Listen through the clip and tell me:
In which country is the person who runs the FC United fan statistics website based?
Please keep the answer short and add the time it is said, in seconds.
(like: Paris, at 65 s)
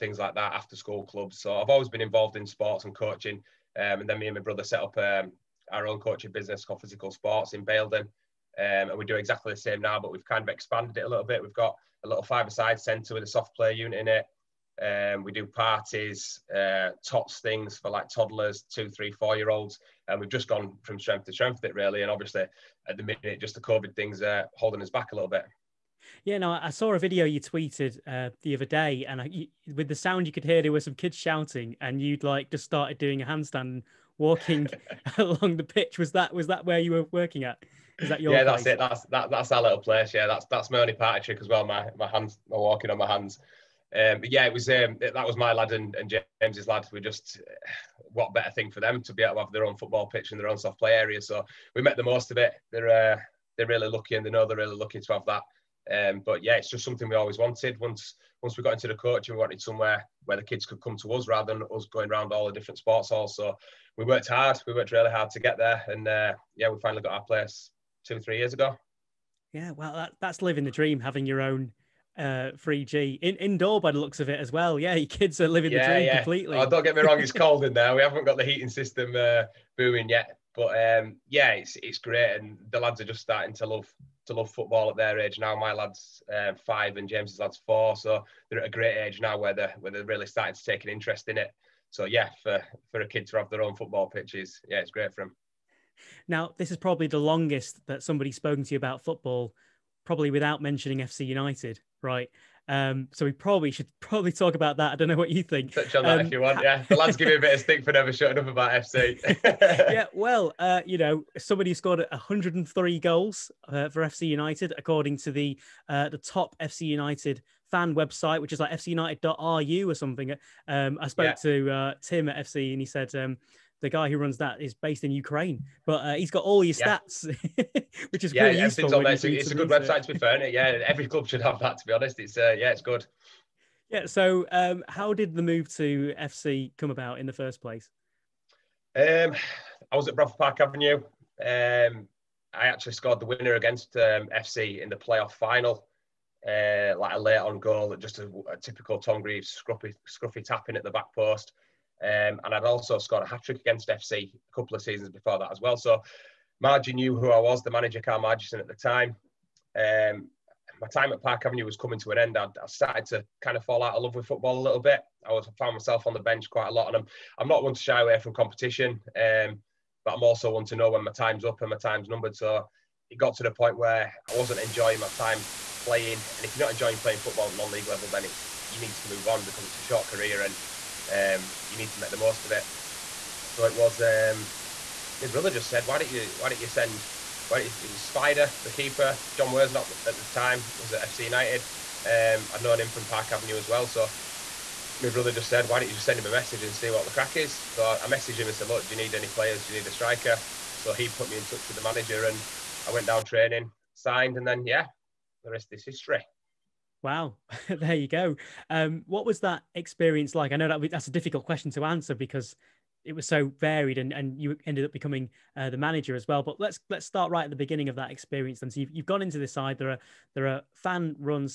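Ukraine, at 125 s.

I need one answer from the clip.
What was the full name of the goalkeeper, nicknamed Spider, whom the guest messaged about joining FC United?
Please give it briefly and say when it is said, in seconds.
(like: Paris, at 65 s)
Jon Worsnop, at 189 s.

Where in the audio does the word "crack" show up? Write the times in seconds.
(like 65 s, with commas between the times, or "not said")
197 s.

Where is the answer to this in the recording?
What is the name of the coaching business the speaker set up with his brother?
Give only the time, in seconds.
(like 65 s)
6 s.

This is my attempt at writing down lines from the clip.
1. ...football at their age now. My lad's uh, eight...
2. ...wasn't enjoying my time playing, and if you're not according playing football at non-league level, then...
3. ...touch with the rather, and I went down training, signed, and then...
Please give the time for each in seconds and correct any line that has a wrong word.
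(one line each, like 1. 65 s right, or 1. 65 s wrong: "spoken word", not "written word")
1. 84 s wrong: "five", not "eight"
2. 174 s wrong: "enjoying", not "according"
3. 201 s wrong: "manager", not "rather".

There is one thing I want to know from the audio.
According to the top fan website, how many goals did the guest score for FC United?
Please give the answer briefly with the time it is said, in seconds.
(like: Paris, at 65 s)
103, at 112 s.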